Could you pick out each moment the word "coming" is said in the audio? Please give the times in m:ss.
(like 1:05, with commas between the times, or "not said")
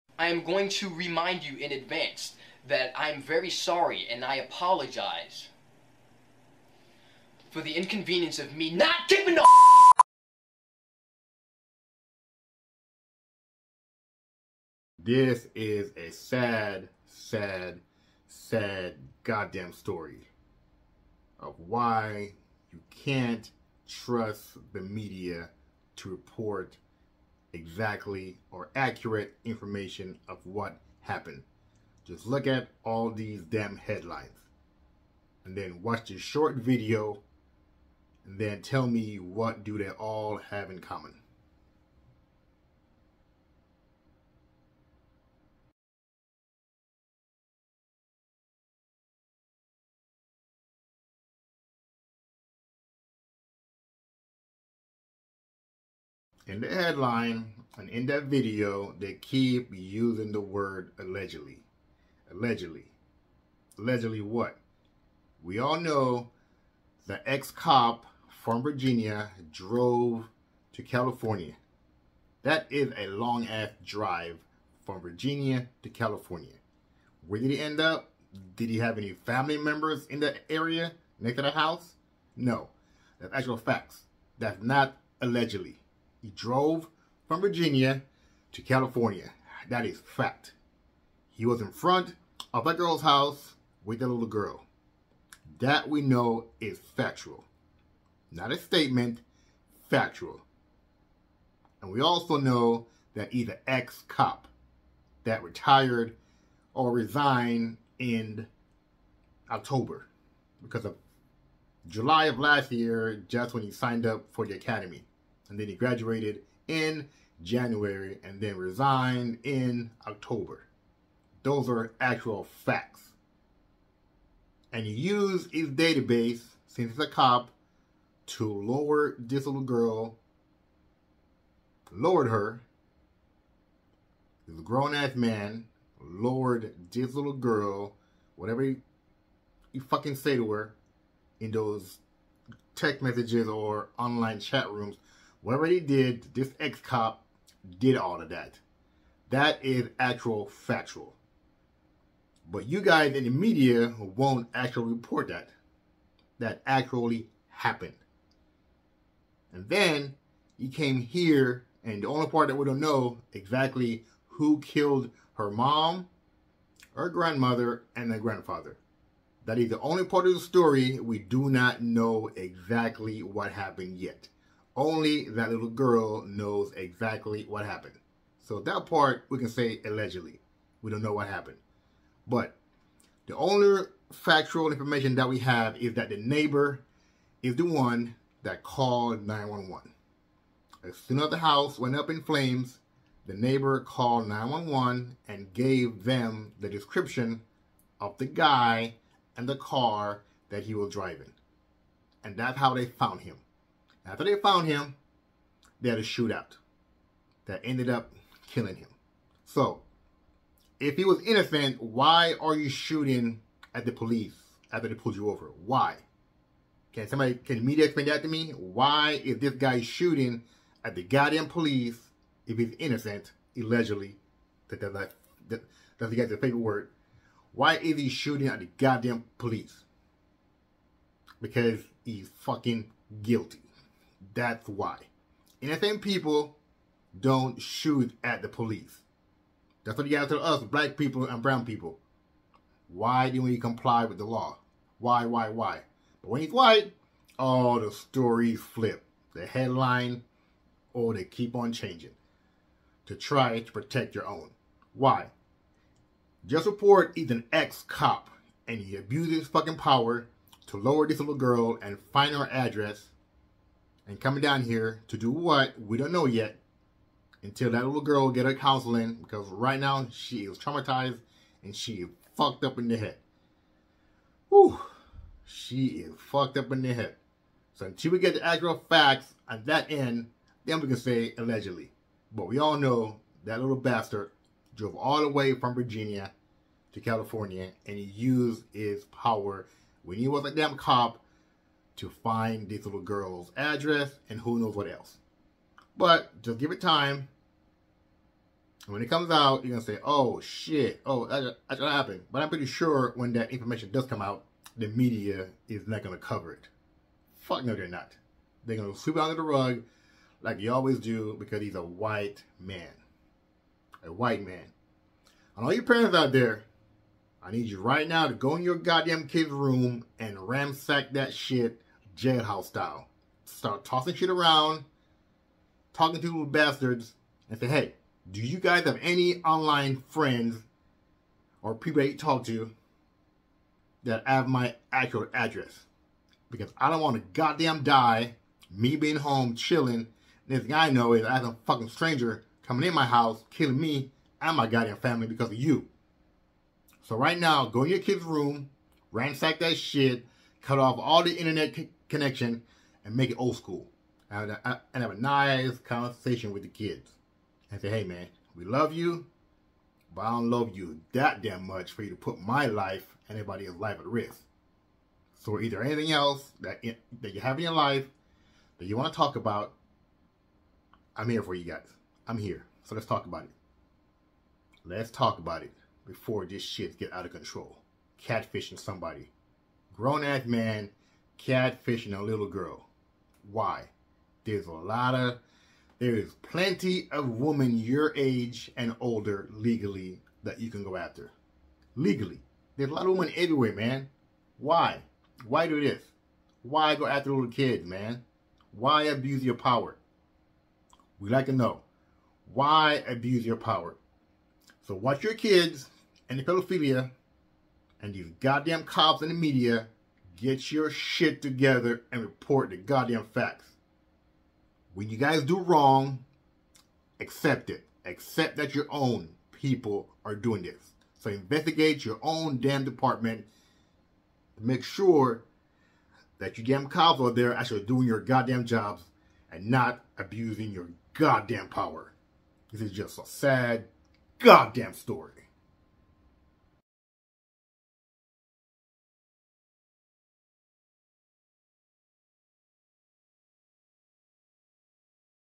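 4:24, 5:42.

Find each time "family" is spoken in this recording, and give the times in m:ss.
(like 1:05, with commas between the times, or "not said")
1:19, 5:44.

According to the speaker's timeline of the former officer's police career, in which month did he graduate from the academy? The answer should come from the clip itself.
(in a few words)
January.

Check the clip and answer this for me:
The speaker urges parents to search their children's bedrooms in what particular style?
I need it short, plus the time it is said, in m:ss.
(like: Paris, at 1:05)
Jailhouse style, at 5:22.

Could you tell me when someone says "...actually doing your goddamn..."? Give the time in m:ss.
7:07.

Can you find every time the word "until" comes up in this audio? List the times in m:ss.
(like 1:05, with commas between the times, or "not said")
4:27, 4:37.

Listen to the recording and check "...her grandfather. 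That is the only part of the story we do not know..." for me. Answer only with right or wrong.
right.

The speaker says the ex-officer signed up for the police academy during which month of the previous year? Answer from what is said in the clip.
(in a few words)
July.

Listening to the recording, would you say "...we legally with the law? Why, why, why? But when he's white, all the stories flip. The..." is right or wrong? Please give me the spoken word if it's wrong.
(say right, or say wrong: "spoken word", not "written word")
wrong: "comply", not "legally".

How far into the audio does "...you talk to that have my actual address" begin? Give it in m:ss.
5:32.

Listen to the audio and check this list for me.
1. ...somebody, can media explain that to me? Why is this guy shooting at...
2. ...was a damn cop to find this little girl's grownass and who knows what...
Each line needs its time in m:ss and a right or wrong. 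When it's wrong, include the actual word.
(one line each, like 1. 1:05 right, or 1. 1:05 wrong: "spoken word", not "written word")
1. 3:37 right
2. 4:50 wrong: "address", not "grownass".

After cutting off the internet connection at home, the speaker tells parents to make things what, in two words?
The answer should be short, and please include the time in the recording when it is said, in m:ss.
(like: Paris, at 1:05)
Old school, at 5:53.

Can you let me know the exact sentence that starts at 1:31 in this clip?
He was in front of that girl's house with that little girl.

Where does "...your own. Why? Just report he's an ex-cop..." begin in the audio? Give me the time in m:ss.
4:14.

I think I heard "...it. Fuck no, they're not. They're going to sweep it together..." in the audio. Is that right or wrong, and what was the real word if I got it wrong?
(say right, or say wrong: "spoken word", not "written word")
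wrong: "under", not "together".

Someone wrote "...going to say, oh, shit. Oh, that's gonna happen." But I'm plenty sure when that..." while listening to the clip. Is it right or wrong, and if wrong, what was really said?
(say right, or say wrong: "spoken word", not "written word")
wrong: "pretty", not "plenty".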